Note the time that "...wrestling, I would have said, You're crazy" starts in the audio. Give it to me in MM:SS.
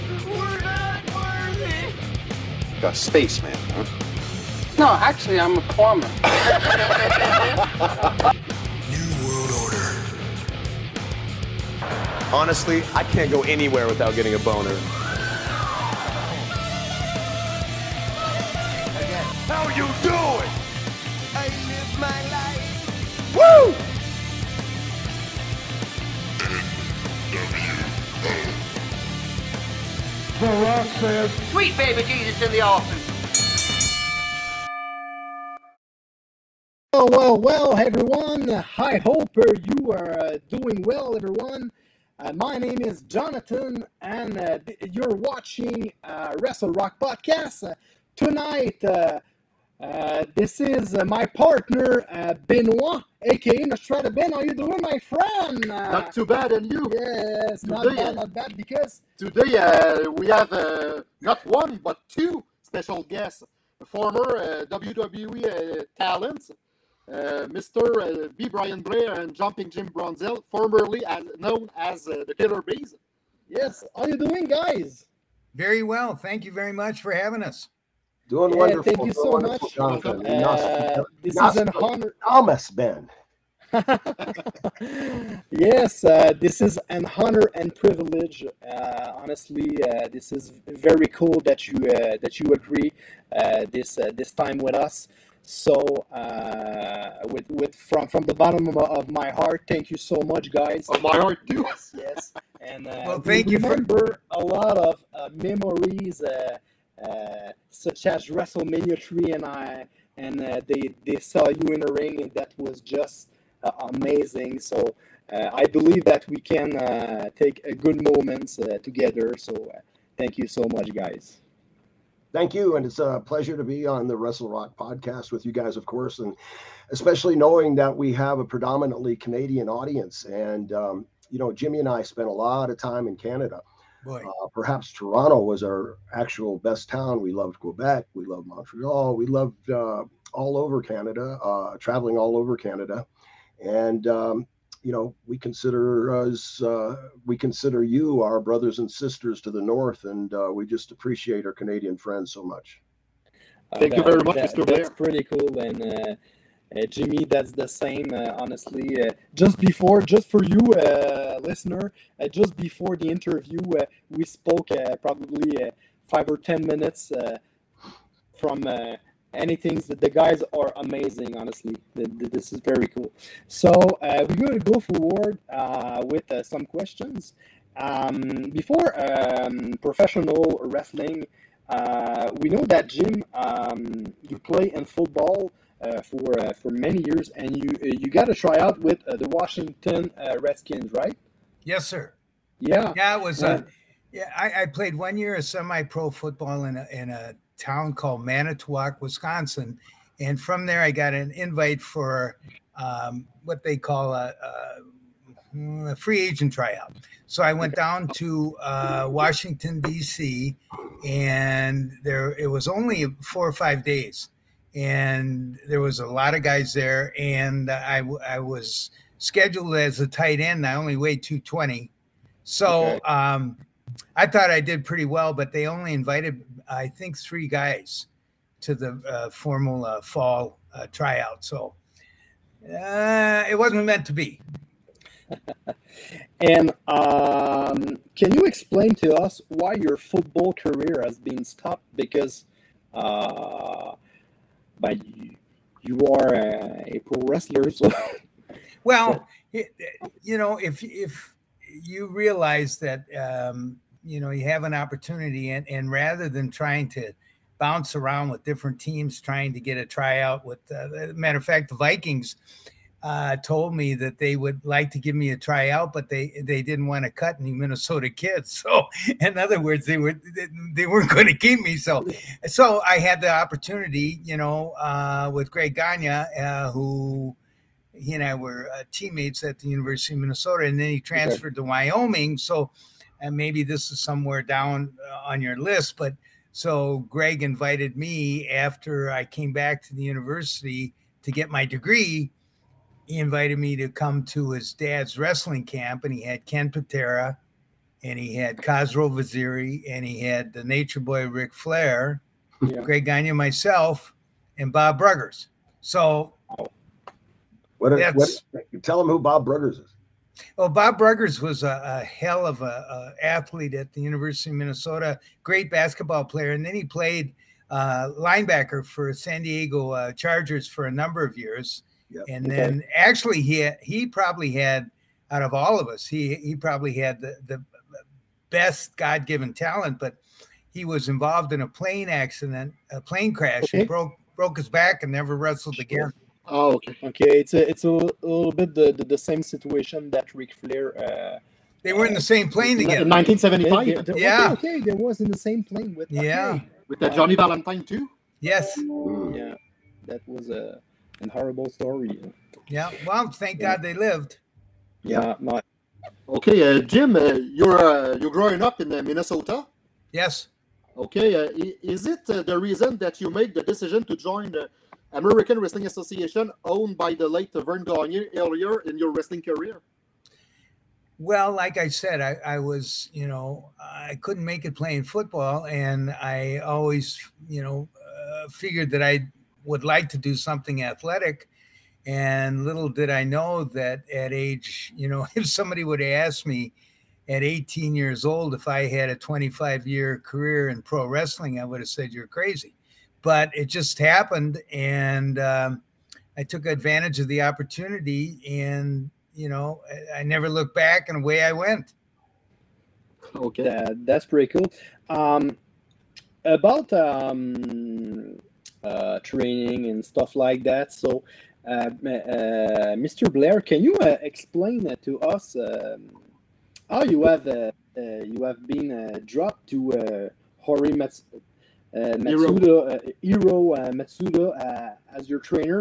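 06:31.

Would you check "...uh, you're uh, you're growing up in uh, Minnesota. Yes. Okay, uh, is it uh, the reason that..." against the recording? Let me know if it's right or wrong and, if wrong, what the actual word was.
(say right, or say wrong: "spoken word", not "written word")
right.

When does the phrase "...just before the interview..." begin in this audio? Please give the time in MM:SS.
02:42.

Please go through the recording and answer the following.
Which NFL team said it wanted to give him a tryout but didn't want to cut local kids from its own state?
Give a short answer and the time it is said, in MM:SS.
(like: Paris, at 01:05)
Vikings, at 04:21.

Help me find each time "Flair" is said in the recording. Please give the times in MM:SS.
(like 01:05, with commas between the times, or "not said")
05:01, 05:40.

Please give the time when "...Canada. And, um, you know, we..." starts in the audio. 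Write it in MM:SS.
02:22.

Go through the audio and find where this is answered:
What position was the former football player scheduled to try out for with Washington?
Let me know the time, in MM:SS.
03:40.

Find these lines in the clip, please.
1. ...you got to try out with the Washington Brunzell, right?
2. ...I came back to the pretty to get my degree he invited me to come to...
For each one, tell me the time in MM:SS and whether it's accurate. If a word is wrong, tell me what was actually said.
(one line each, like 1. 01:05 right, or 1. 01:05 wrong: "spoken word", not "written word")
1. 03:07 wrong: "Redskins", not "Brunzell"
2. 04:49 wrong: "university", not "pretty".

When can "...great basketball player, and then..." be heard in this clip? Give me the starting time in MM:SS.
05:15.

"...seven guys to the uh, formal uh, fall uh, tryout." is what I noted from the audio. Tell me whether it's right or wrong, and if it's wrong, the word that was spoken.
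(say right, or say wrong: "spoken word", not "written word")
wrong: "three", not "seven".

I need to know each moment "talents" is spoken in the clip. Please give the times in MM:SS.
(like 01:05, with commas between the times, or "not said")
01:05, 05:29.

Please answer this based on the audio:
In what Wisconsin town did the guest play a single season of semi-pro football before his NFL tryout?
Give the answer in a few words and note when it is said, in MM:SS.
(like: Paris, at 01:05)
Manitowoc, at 03:18.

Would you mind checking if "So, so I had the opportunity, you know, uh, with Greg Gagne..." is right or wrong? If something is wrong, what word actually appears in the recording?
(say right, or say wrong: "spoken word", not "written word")
right.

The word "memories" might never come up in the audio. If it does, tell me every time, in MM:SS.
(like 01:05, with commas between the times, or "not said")
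01:45.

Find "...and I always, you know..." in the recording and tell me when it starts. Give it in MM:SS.
06:15.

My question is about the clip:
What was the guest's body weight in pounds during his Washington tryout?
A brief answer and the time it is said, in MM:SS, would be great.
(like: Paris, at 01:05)
220, at 03:41.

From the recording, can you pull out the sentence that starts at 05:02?
Greg Gagne, myself, and Bob Bruggers.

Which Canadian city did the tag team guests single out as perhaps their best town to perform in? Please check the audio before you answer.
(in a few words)
Toronto.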